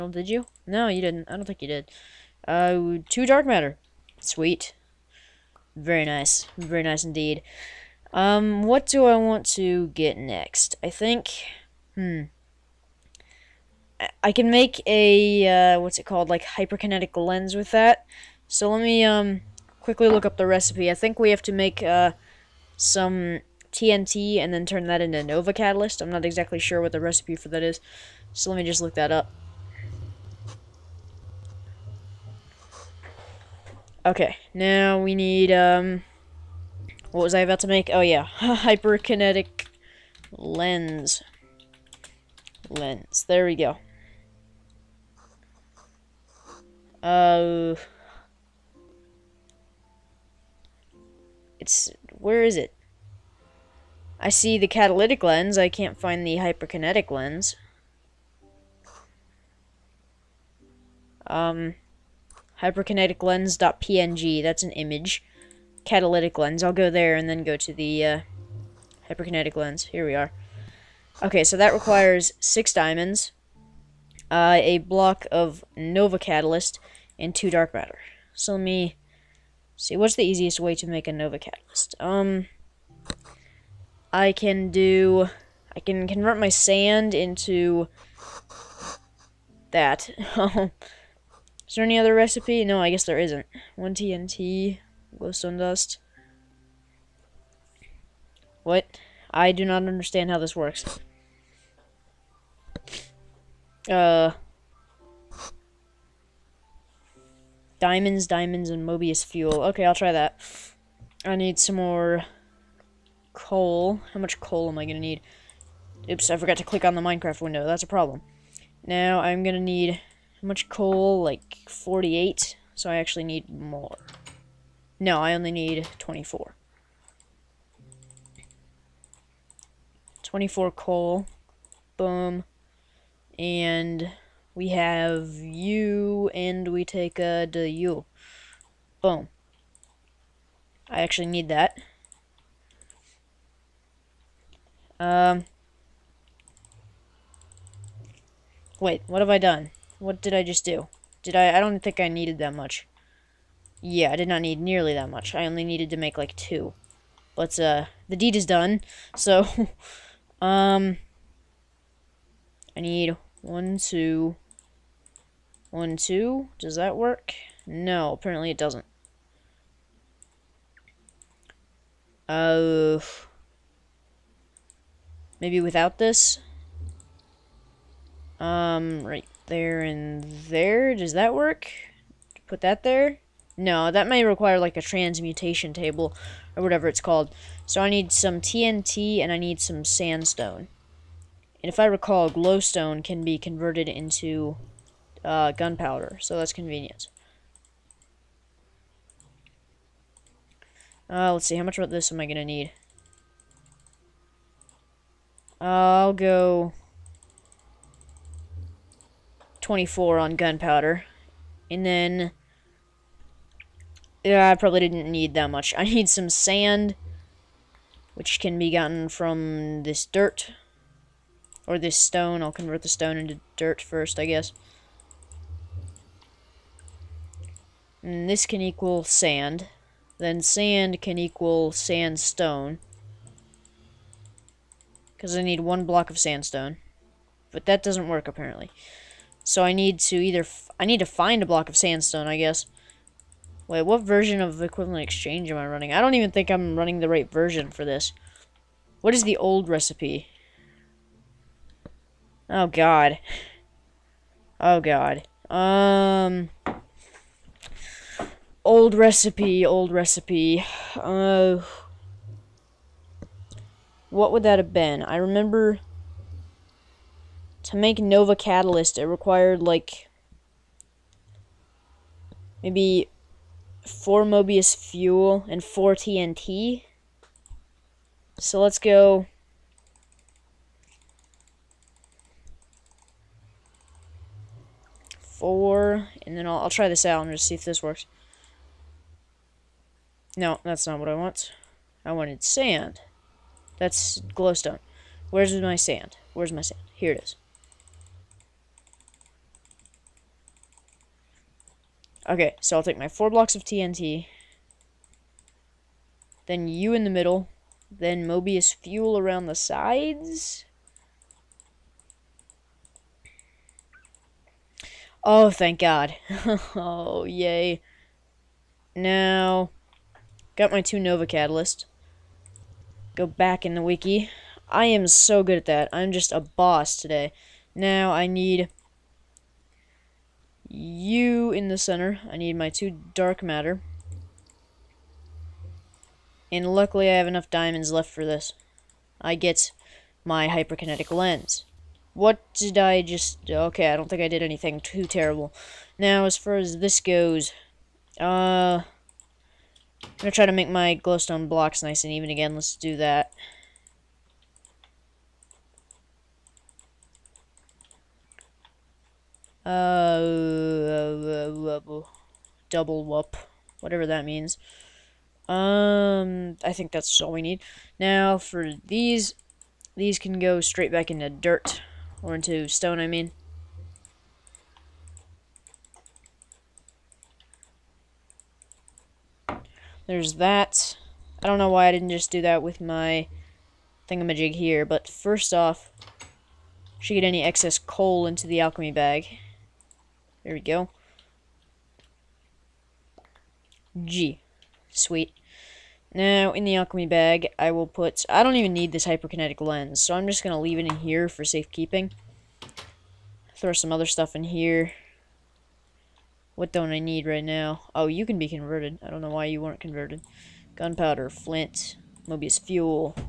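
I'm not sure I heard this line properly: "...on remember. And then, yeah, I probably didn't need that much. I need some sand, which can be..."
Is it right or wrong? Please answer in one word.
wrong.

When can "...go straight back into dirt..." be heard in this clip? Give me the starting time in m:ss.
6:10.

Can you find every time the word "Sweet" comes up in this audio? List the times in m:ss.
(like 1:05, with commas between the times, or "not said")
0:04, 6:34.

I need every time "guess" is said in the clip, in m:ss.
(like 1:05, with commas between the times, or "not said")
1:32, 3:44, 4:02.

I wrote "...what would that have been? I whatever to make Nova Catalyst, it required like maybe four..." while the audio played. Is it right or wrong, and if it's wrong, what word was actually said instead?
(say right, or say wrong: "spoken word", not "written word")
wrong: "remember", not "whatever".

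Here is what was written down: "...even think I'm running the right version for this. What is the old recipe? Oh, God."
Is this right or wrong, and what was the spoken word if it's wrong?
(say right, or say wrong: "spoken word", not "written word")
right.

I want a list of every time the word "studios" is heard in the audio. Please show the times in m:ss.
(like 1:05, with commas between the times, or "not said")
not said.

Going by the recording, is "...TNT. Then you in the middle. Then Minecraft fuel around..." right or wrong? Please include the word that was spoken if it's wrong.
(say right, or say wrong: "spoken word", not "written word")
wrong: "Mobius", not "Minecraft".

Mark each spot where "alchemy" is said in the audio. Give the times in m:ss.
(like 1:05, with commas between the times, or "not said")
6:28, 6:36.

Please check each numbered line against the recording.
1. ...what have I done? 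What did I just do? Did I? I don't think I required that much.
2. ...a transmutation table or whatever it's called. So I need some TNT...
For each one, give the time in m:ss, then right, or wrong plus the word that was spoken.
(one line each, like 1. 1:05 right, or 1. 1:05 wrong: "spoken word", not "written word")
1. 2:29 wrong: "needed", not "required"
2. 3:04 right.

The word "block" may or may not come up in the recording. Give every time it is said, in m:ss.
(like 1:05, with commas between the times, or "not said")
1:14, 3:55, 4:01, 5:03, 5:51.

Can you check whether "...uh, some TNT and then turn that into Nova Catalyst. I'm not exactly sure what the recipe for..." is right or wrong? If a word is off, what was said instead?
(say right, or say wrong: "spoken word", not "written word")
right.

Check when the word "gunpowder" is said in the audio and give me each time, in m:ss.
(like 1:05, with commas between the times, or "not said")
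3:15, 3:30, 6:50.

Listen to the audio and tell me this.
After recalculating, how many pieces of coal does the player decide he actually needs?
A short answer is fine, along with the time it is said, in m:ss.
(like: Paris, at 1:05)
24, at 2:10.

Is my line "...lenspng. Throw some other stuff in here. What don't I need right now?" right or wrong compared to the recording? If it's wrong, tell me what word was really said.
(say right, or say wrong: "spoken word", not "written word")
wrong: "safekeeping", not "lenspng".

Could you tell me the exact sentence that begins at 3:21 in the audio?
Uh, let's see, how much of this am I going to need?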